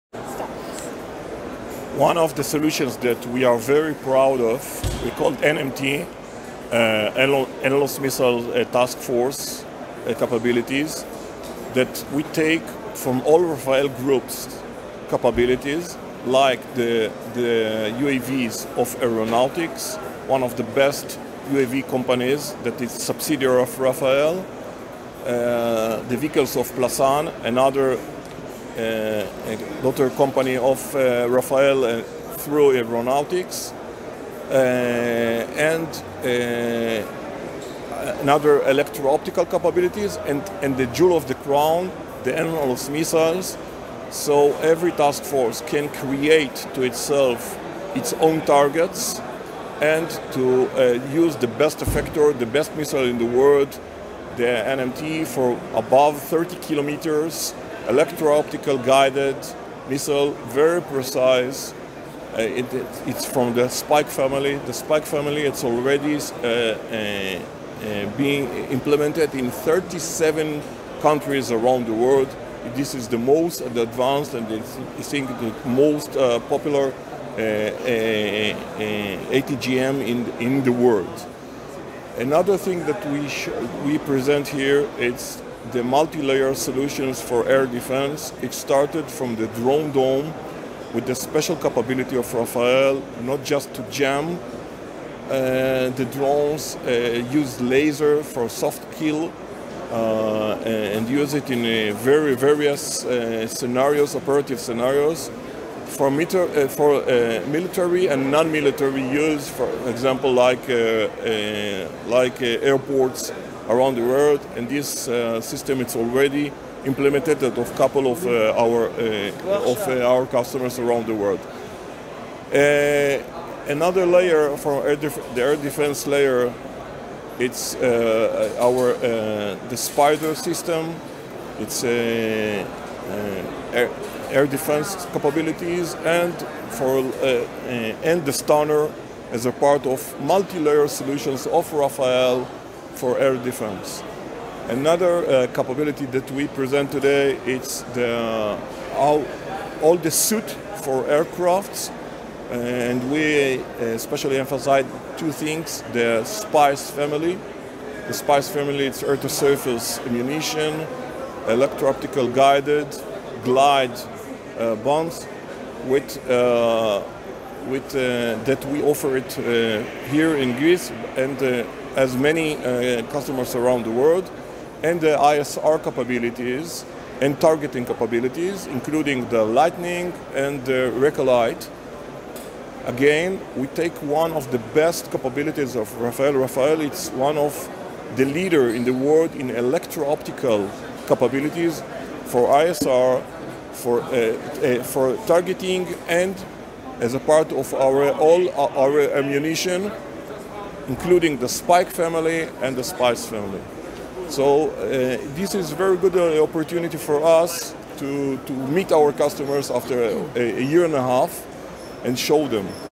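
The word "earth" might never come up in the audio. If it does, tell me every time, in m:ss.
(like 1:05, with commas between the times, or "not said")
2:39.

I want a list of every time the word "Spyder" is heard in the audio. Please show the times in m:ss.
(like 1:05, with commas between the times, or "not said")
2:09.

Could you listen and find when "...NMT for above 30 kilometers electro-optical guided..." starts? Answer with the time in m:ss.
0:54.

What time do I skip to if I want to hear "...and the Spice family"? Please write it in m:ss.
3:22.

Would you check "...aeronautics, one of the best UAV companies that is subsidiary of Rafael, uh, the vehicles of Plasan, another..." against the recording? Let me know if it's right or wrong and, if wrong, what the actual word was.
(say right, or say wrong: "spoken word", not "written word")
right.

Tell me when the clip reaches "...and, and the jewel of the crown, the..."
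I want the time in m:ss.
0:40.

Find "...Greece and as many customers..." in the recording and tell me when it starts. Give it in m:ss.
2:50.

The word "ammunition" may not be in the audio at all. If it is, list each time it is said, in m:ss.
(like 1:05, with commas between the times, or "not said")
2:40, 3:19.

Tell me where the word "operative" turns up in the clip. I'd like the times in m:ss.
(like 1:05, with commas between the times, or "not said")
1:44.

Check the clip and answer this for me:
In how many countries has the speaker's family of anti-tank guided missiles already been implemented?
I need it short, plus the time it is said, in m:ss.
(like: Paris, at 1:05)
37, at 1:09.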